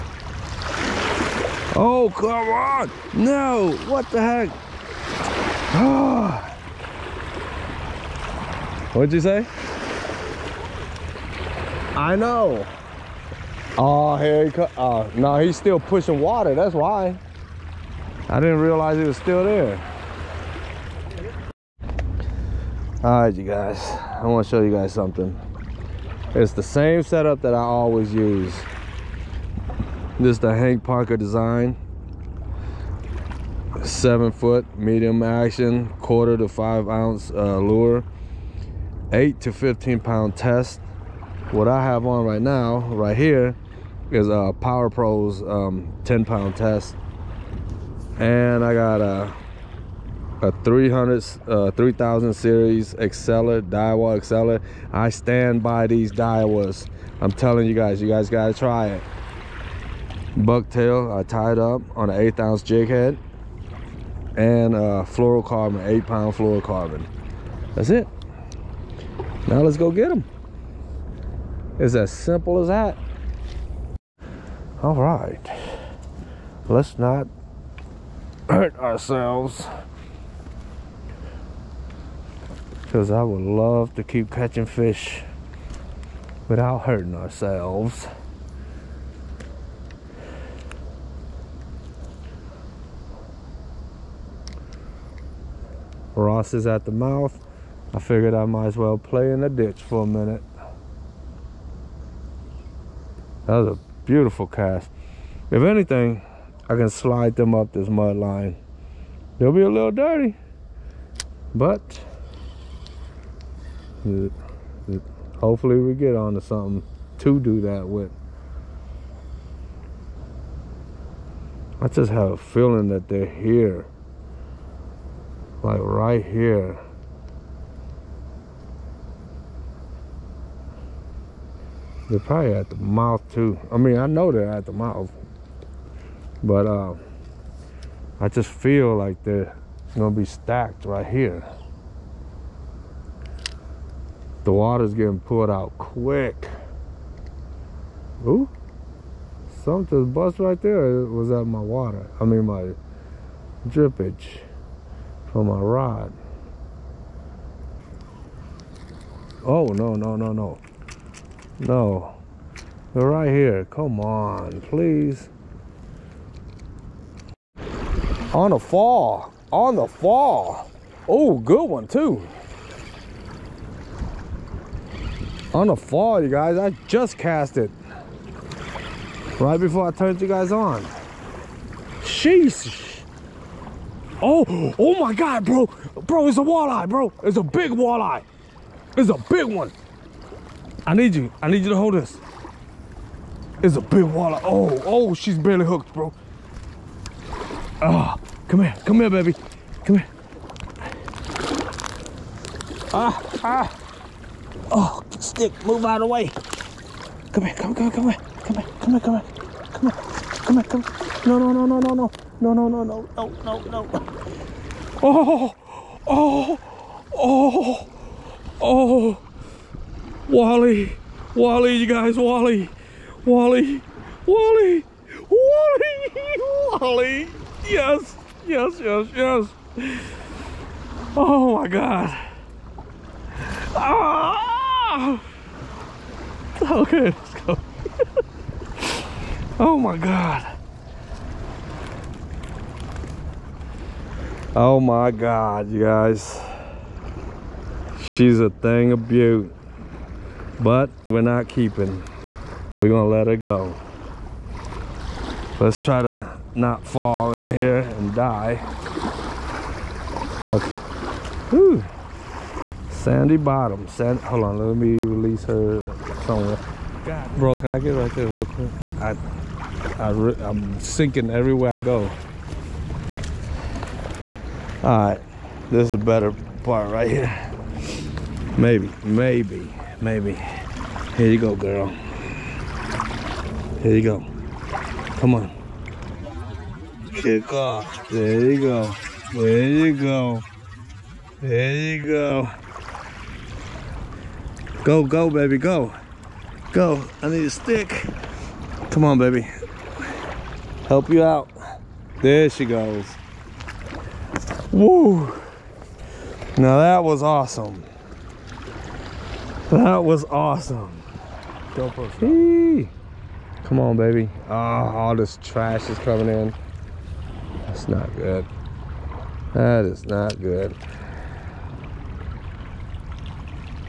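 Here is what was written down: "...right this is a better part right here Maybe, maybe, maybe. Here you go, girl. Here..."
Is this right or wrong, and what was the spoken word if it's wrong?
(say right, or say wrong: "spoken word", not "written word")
right.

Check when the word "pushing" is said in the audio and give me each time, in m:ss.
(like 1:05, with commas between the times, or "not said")
0:15.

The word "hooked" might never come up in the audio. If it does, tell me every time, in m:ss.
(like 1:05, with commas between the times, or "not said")
3:15.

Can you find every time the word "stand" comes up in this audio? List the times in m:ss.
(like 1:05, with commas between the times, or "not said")
0:55.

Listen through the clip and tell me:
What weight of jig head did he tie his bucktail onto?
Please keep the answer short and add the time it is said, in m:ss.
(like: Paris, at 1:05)
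1/8 ounce, at 1:02.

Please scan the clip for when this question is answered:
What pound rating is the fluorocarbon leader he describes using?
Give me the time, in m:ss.
1:05.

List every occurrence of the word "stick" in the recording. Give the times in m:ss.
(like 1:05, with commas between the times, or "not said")
3:25, 4:57.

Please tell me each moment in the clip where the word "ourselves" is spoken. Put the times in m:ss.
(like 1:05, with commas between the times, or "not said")
1:18, 1:27.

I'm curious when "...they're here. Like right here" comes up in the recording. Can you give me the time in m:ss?
2:03.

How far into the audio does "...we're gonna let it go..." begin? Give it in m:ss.
4:12.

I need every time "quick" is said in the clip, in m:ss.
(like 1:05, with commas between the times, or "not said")
2:25, 4:28.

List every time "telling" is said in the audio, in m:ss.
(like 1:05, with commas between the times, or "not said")
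0:57.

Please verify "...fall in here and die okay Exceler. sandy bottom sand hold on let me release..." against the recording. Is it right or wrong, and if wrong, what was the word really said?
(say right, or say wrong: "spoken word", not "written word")
wrong: "Whew", not "Exceler".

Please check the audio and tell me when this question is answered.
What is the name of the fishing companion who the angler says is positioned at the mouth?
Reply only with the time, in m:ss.
1:36.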